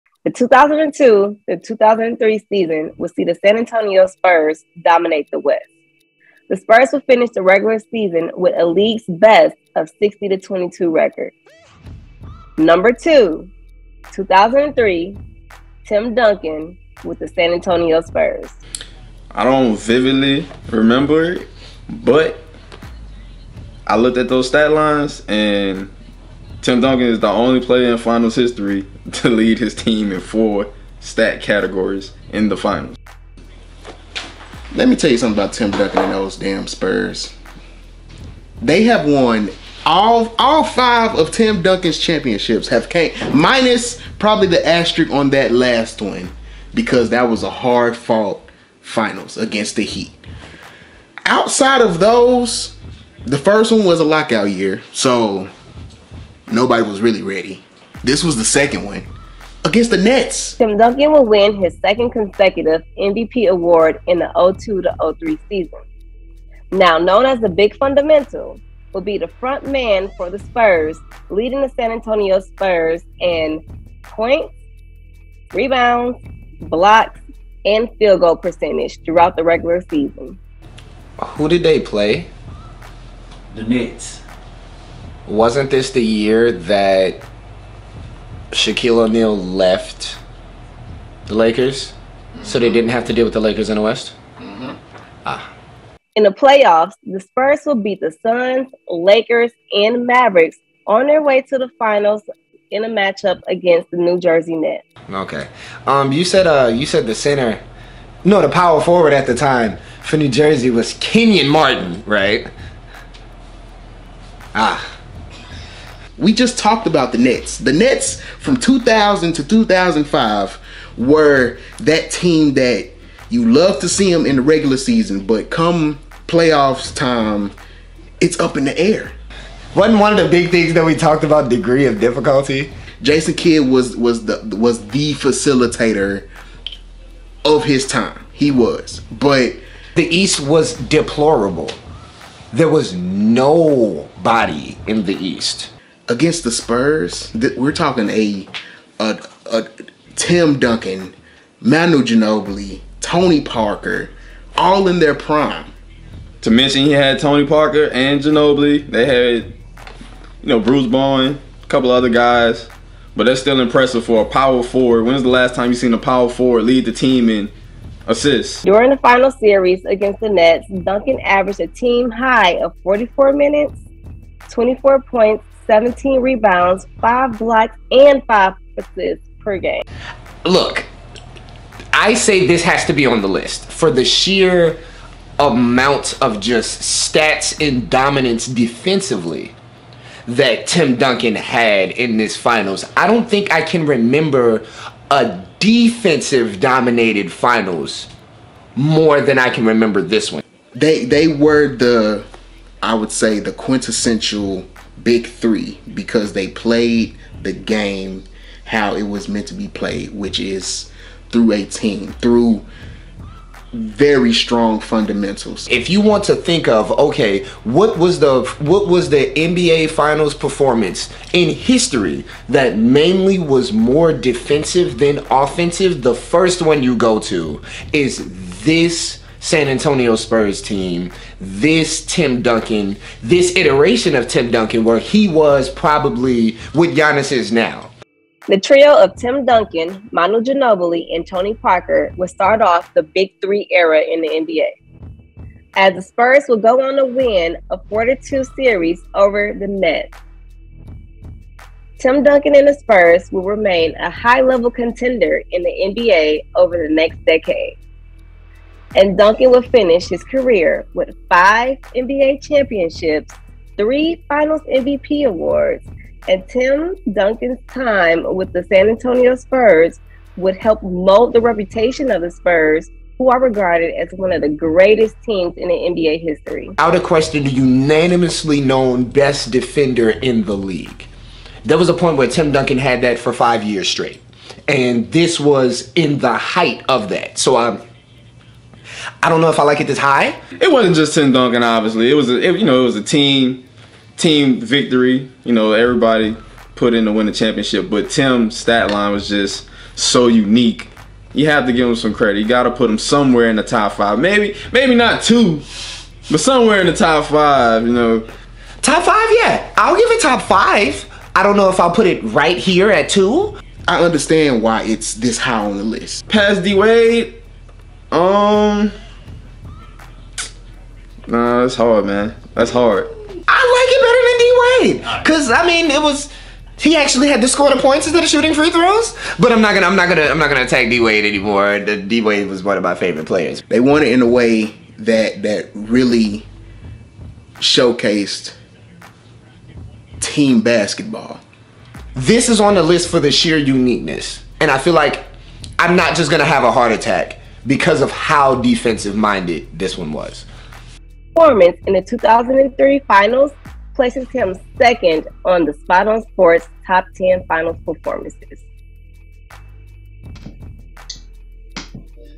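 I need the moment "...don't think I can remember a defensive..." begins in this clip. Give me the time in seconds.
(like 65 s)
193 s.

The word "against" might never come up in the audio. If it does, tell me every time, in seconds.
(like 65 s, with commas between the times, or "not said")
49 s, 59 s, 103 s, 146 s, 169 s.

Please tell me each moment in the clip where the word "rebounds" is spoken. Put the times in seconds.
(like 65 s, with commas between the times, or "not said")
75 s, 176 s.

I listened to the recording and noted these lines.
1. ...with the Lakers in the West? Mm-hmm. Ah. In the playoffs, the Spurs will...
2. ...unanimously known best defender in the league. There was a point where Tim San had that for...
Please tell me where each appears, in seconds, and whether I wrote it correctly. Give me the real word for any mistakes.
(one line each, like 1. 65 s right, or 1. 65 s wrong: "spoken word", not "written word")
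1. 93 s right
2. 277 s wrong: "Duncan", not "San".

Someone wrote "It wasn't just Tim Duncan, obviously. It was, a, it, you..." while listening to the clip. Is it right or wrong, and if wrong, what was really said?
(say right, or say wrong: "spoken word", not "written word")
right.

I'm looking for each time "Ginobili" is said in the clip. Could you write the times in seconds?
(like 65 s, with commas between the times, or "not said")
152 s, 158 s, 240 s.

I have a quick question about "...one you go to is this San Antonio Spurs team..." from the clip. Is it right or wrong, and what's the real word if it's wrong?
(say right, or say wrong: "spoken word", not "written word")
right.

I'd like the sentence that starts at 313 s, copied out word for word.
I understand why it's this high on the list.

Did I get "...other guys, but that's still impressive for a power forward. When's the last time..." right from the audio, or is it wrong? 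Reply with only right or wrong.
right.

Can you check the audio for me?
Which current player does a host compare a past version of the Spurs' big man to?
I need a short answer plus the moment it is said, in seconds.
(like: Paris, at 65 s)
Giannis, at 236 s.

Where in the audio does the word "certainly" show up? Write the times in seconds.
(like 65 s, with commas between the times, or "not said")
not said.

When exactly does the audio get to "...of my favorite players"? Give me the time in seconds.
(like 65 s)
332 s.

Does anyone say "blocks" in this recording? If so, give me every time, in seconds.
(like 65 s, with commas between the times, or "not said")
76 s, 177 s.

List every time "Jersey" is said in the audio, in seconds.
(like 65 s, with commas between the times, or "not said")
104 s, 110 s.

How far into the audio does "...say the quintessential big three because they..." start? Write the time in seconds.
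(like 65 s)
203 s.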